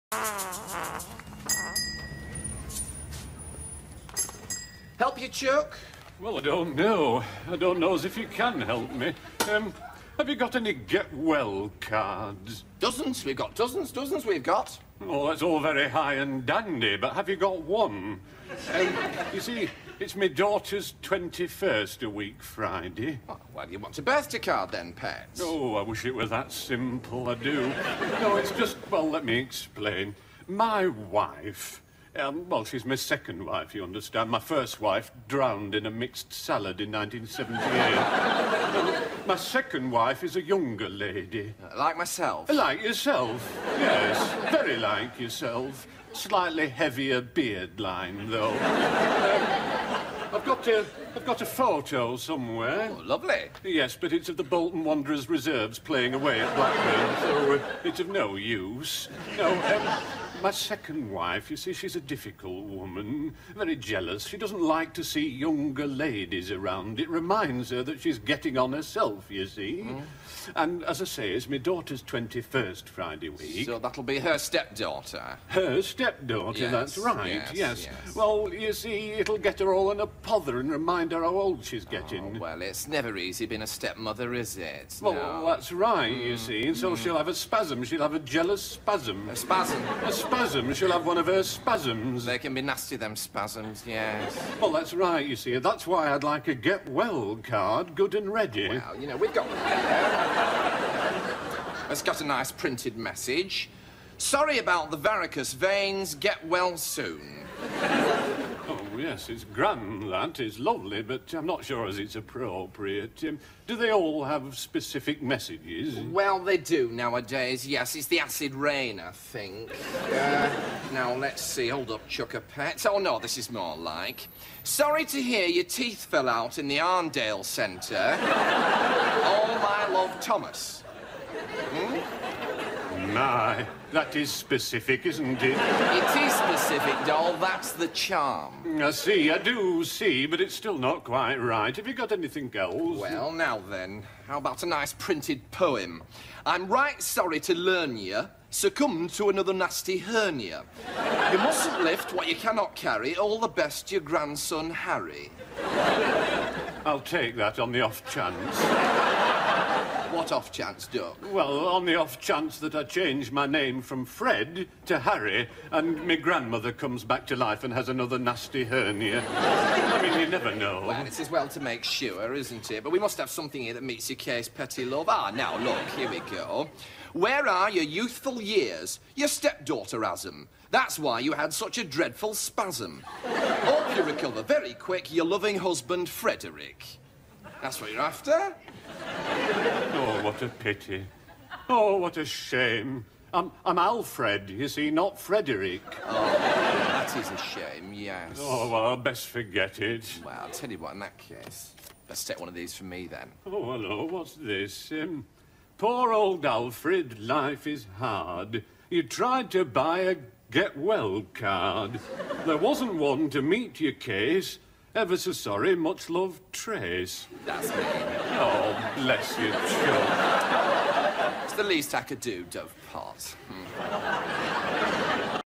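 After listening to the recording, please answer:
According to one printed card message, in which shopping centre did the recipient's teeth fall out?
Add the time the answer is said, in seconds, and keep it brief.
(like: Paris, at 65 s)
Arndale Centre, at 126 s.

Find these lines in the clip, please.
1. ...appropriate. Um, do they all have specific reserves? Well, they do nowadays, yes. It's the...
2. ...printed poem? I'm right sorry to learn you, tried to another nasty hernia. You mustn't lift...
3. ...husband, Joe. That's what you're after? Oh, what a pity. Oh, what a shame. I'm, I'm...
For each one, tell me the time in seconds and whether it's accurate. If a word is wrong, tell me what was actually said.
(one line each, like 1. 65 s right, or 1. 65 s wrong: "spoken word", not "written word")
1. 112 s wrong: "messages", not "reserves"
2. 144 s wrong: "succumbed", not "tried"
3. 185 s wrong: "Frederick", not "Joe".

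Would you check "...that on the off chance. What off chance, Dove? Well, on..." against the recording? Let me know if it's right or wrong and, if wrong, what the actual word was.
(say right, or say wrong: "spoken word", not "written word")
wrong: "Doc", not "Dove".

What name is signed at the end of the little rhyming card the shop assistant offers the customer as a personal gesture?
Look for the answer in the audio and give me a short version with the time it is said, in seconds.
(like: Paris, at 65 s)
Trace, at 216 s.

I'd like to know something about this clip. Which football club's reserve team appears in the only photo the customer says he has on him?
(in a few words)
Bolton Wanderers.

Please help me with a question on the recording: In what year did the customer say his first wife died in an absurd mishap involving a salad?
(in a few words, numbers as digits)
1978.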